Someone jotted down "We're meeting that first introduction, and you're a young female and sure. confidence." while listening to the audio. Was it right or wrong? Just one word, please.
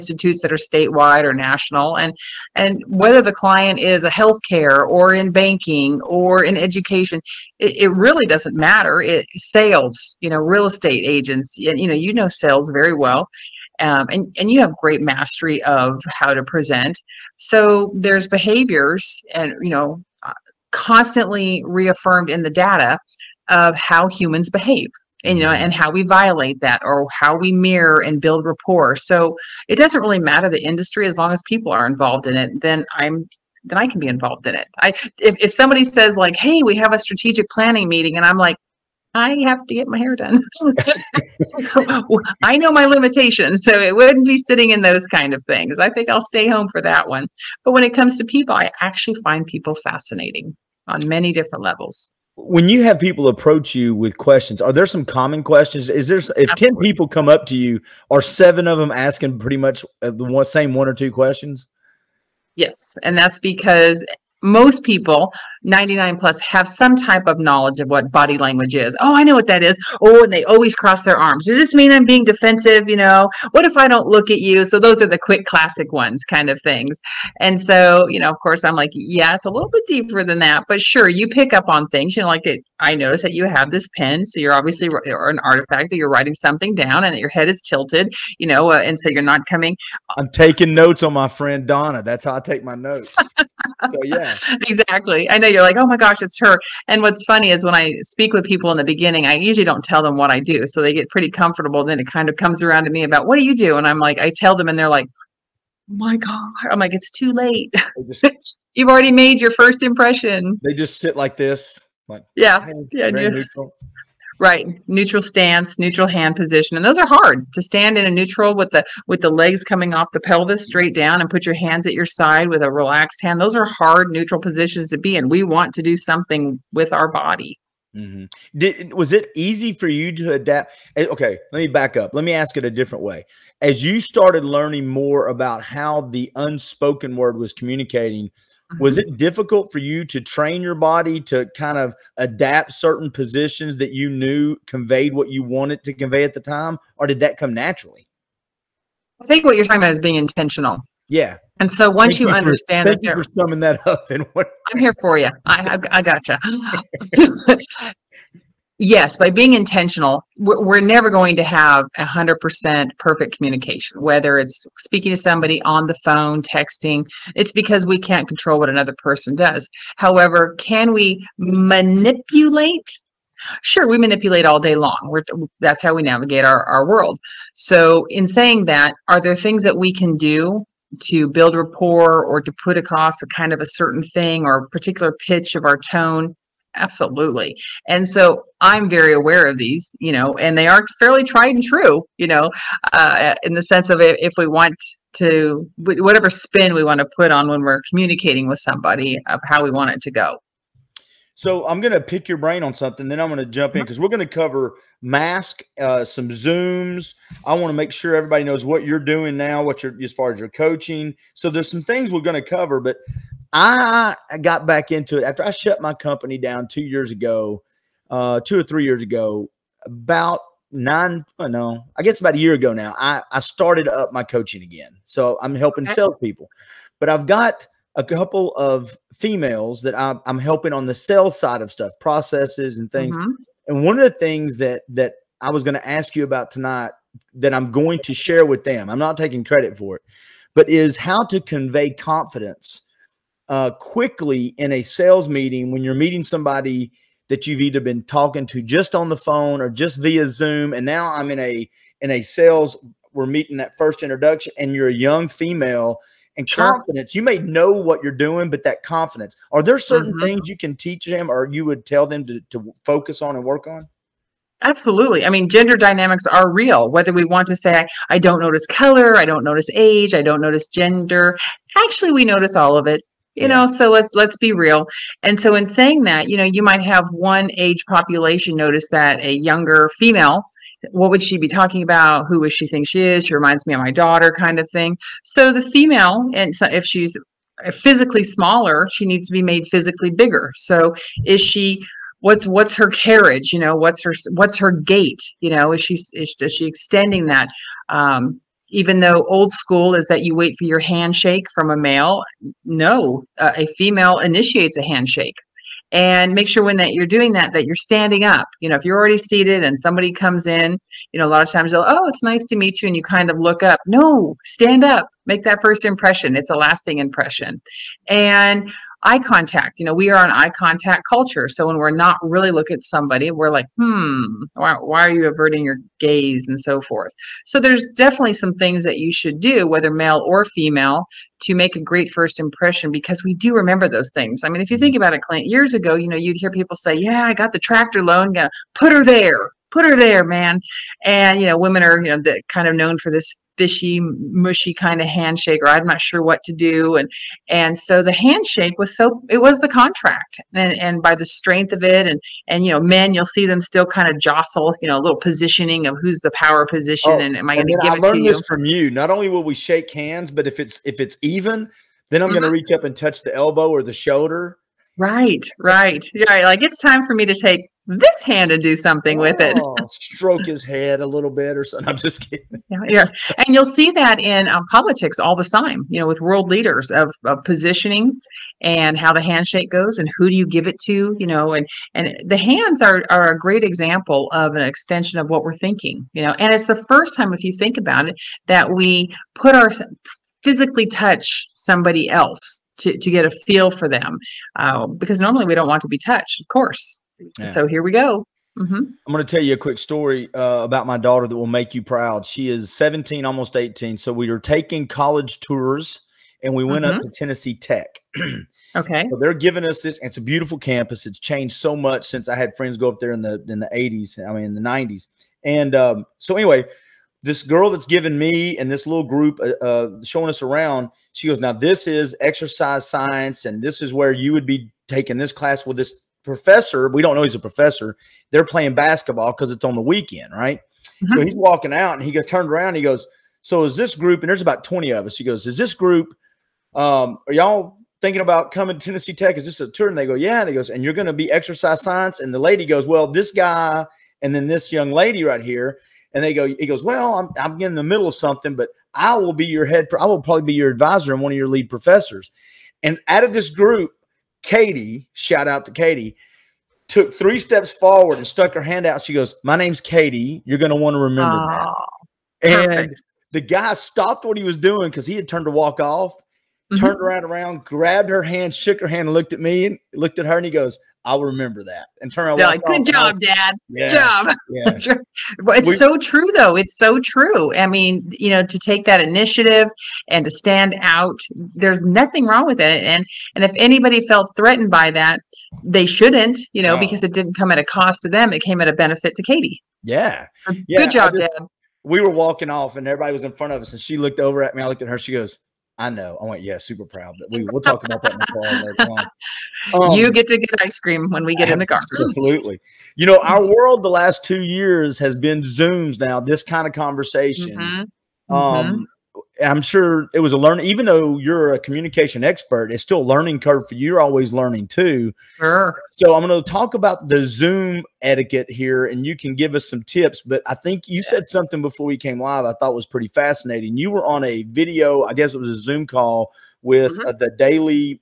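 right.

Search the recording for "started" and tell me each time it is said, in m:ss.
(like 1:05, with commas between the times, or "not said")
2:13, 3:43.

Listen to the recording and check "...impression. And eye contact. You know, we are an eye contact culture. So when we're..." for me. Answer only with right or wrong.
right.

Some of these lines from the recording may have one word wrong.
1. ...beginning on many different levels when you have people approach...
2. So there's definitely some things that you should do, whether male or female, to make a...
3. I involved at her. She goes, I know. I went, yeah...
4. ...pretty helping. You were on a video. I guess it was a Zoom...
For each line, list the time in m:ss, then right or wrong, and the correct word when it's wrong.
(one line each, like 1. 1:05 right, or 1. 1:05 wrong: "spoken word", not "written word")
1. 0:49 wrong: "fascinating", not "beginning"
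2. 5:27 right
3. 8:14 wrong: "looked", not "involved"
4. 8:42 wrong: "fascinating", not "helping".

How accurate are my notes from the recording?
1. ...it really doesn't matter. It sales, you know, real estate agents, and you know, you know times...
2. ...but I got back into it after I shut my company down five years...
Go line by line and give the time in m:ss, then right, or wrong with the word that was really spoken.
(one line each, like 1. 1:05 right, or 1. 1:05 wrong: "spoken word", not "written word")
1. 0:07 wrong: "sales", not "times"
2. 3:32 wrong: "two", not "five".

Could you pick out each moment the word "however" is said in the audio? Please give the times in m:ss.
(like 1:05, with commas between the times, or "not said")
2:49.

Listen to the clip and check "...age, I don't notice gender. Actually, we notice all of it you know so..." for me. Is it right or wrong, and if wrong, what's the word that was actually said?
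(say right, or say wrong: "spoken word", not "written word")
right.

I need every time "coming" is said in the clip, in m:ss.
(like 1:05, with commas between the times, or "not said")
1:29, 1:59, 7:18.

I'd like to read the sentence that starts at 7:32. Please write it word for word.
And out of this group, Katie, shout out to Katie, took three steps forward and stuck her hand out.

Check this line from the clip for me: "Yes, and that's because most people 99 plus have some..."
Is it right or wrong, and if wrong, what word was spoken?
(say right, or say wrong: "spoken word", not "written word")
right.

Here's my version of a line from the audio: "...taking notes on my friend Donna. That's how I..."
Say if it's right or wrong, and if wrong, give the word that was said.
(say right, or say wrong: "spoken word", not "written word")
right.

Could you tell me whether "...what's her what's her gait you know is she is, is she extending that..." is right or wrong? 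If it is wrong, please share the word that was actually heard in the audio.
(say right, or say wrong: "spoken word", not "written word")
right.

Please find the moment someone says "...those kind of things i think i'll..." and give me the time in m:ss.
0:44.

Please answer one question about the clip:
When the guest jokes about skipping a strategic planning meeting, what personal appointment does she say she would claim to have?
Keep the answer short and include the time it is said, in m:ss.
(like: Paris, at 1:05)
get my hair done, at 0:39.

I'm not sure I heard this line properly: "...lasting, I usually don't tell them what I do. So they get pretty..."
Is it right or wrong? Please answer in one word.
wrong.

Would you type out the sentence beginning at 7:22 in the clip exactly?
And the lady goes, Well, this guy and then this young lady right here.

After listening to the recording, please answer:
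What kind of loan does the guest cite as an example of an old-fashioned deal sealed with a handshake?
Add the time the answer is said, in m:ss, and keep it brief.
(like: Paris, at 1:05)
tractor loan, at 5:37.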